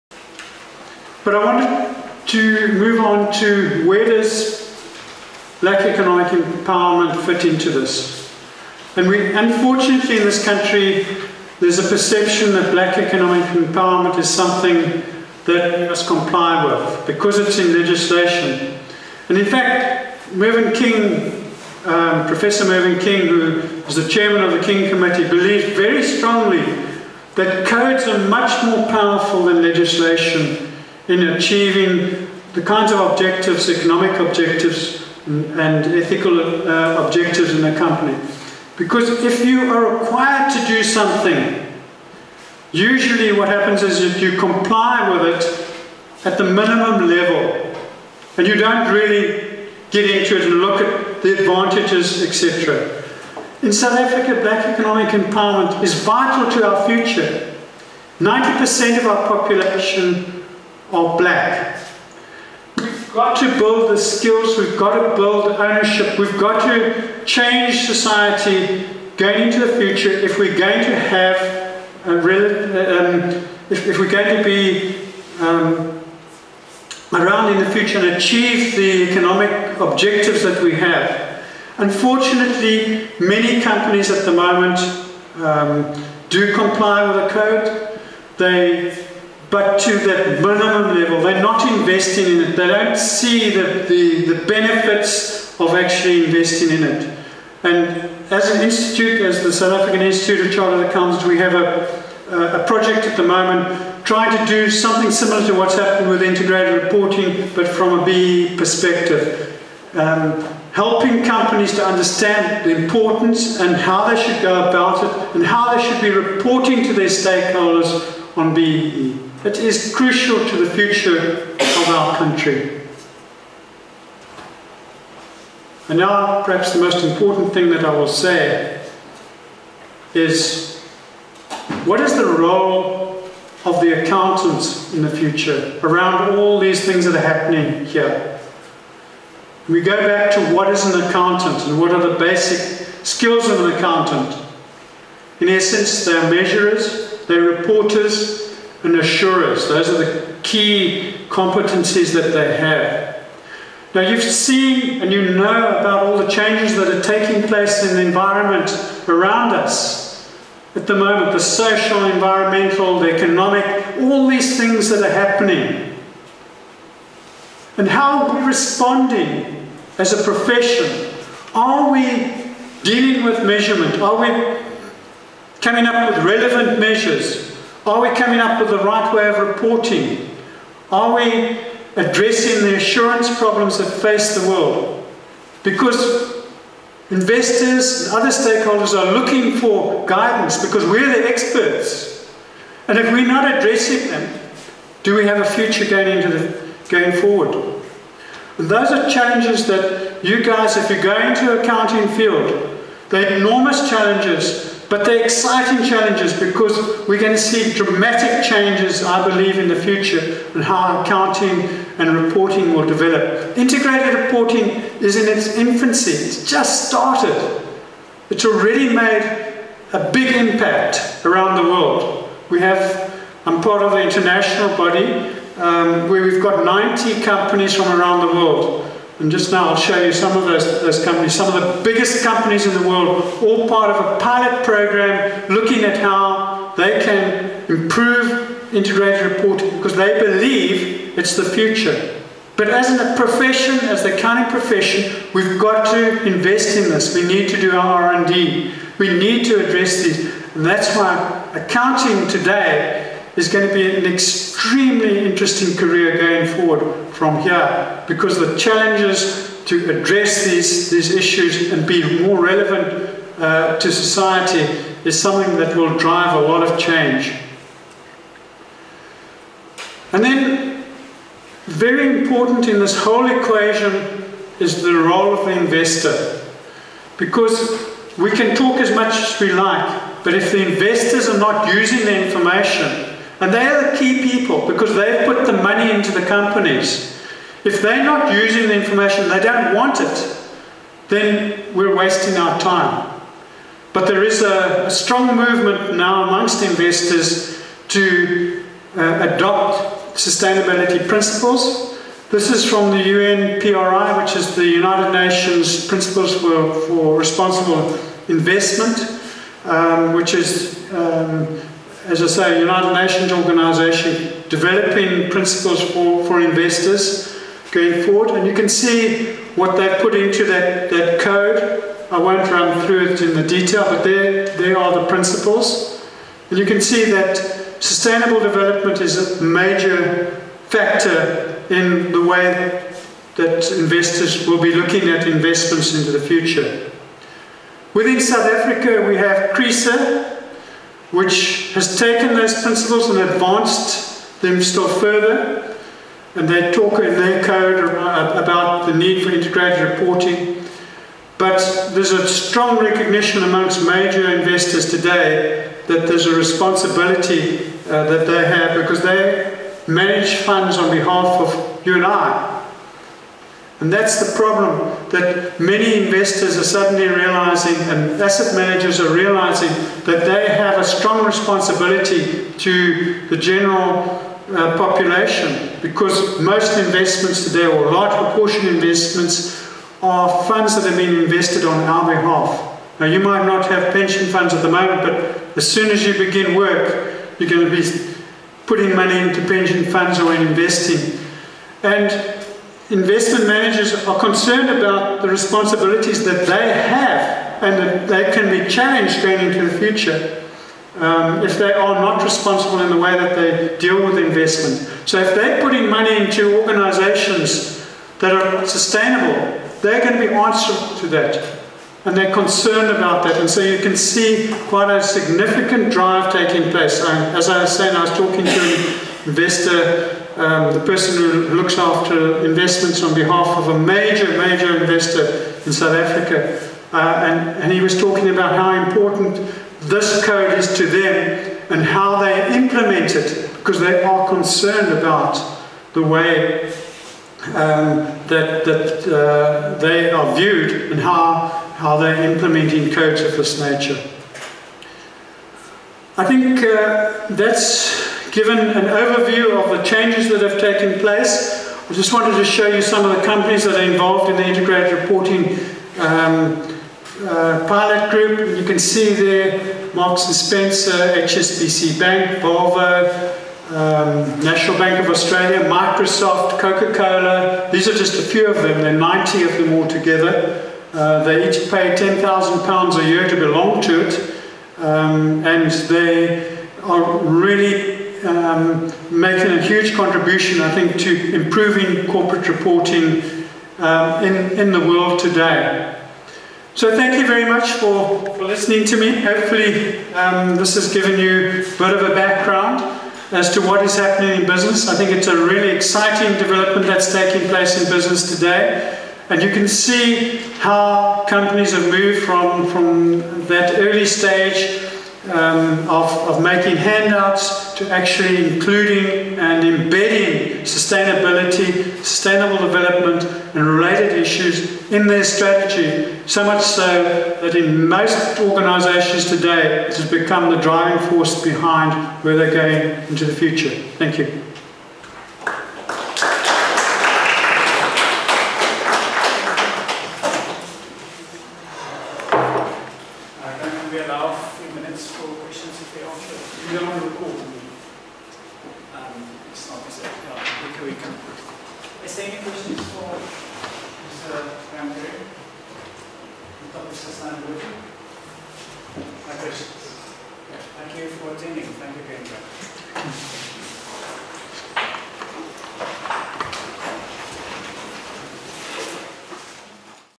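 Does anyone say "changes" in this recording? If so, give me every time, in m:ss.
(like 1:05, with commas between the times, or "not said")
1:07, 2:36, 3:28, 4:26, 7:29.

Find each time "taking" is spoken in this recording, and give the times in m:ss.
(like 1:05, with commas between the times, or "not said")
2:37, 6:56, 8:17.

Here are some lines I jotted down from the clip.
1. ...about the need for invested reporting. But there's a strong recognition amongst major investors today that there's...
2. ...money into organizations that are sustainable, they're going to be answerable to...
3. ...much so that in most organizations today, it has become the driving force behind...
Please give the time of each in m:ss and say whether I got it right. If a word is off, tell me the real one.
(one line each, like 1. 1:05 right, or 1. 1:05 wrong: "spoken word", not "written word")
1. 5:47 wrong: "integrated", not "invested"
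2. 6:45 right
3. 8:36 right.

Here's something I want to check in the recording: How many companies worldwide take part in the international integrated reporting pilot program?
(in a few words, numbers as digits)
90.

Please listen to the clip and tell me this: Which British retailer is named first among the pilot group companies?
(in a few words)
Marks and Spencer.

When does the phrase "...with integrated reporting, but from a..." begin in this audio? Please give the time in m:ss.
1:46.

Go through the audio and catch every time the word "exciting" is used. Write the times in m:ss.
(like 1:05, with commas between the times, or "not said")
3:25, 8:15.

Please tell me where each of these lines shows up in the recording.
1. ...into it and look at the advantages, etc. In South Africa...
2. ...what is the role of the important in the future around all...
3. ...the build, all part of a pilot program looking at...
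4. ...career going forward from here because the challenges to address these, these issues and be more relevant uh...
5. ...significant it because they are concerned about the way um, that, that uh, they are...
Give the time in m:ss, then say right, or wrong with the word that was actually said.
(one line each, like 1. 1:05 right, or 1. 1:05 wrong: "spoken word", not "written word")
1. 0:50 right
2. 2:11 wrong: "accountant", not "important"
3. 3:52 wrong: "world", not "build"
4. 4:15 right
5. 7:12 wrong: "implement", not "significant".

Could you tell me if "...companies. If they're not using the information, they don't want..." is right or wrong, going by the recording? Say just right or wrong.
right.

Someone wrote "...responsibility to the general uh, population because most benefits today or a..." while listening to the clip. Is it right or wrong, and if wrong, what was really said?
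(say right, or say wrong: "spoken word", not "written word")
wrong: "investments", not "benefits".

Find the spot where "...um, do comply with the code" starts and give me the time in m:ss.
1:25.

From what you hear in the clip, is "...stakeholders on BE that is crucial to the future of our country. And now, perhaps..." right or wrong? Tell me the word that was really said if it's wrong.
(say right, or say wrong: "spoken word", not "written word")
right.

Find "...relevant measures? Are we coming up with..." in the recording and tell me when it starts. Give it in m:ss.
2:56.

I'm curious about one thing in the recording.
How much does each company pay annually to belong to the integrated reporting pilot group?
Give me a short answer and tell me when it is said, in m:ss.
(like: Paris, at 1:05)
£10,000, at 7:51.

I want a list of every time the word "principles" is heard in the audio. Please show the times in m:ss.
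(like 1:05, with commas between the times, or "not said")
5:01, 5:05, 5:15, 5:25, 5:42.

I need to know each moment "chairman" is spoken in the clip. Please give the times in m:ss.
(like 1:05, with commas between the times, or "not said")
0:24.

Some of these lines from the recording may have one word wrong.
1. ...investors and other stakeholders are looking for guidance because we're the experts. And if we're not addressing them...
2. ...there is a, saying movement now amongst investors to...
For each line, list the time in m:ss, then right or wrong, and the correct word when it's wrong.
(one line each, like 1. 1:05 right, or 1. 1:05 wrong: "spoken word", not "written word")
1. 3:07 right
2. 4:54 wrong: "strong", not "saying".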